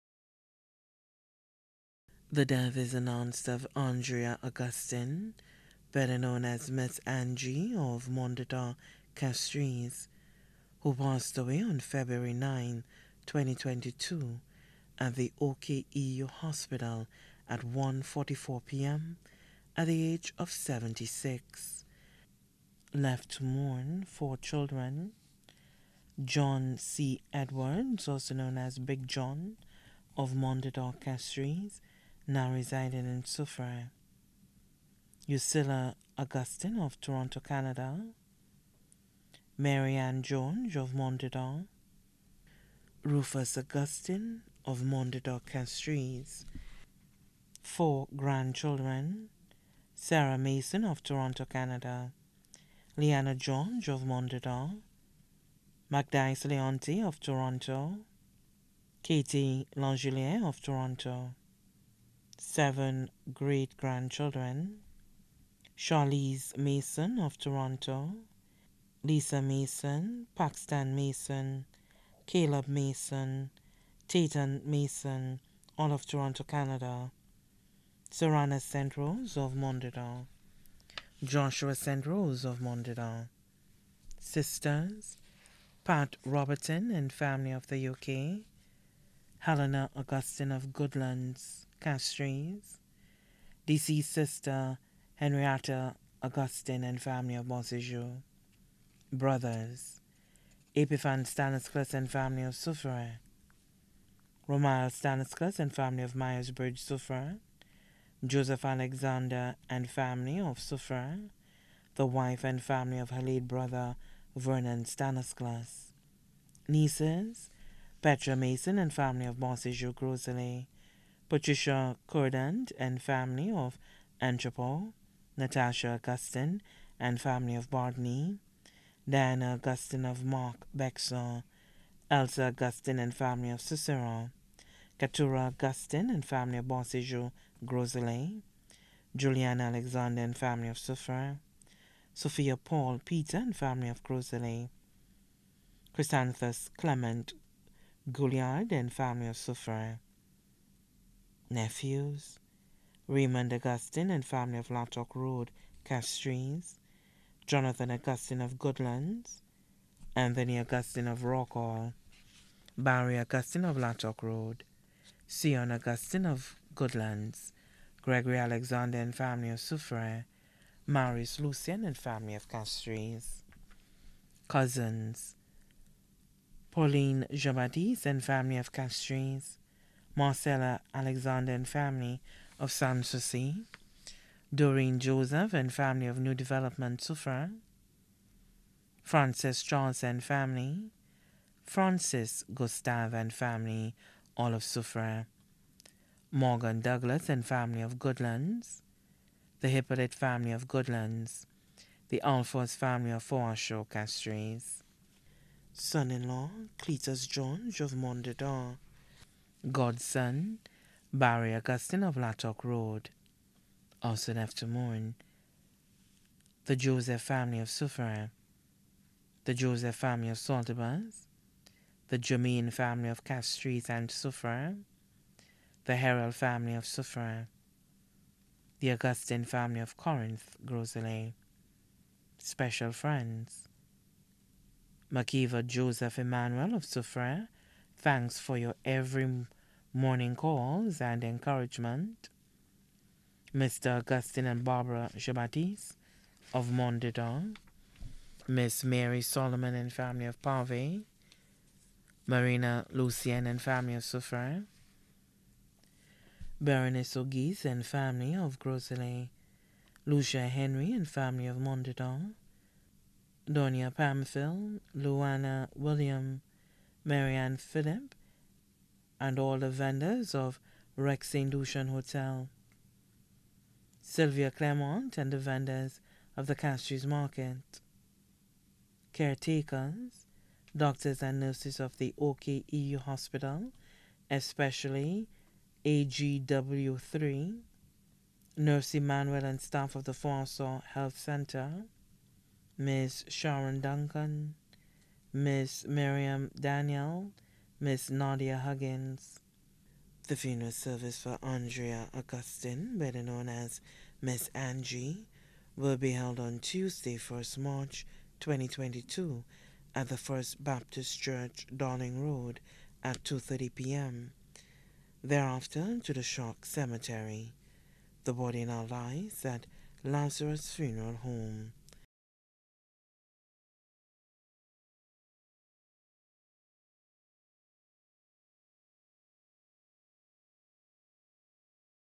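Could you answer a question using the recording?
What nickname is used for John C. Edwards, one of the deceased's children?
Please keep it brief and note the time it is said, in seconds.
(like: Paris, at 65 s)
Big John, at 28 s.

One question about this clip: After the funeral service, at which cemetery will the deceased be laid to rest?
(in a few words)
Choc Cemetery.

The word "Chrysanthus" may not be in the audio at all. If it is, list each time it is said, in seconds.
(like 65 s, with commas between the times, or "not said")
145 s.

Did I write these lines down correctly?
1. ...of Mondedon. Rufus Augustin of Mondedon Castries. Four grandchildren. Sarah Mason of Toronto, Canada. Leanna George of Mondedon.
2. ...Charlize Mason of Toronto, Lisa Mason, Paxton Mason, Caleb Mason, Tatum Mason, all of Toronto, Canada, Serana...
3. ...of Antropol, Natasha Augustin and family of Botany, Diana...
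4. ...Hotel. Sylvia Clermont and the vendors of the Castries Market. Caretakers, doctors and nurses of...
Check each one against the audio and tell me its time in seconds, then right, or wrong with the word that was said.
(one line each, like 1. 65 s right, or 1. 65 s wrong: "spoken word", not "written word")
1. 40 s right
2. 65 s right
3. 123 s right
4. 271 s right.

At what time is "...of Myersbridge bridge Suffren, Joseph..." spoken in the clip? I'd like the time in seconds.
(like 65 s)
106 s.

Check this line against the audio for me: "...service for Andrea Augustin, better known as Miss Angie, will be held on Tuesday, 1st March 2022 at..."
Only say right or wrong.
right.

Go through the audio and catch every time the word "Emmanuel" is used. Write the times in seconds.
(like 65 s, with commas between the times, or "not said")
236 s, 288 s.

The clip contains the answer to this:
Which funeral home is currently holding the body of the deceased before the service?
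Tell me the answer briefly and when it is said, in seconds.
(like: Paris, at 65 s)
Lazarus Funeral Home, at 320 s.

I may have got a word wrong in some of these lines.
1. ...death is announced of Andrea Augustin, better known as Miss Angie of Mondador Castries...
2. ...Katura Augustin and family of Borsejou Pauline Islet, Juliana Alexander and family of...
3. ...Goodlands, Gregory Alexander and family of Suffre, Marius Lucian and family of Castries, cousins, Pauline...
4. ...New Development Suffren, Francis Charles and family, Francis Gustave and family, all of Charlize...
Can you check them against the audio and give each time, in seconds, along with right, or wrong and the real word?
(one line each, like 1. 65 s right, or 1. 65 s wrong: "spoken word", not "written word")
1. 2 s right
2. 134 s wrong: "Gros", not "Pauline"
3. 166 s right
4. 186 s wrong: "Suffren", not "Charlize".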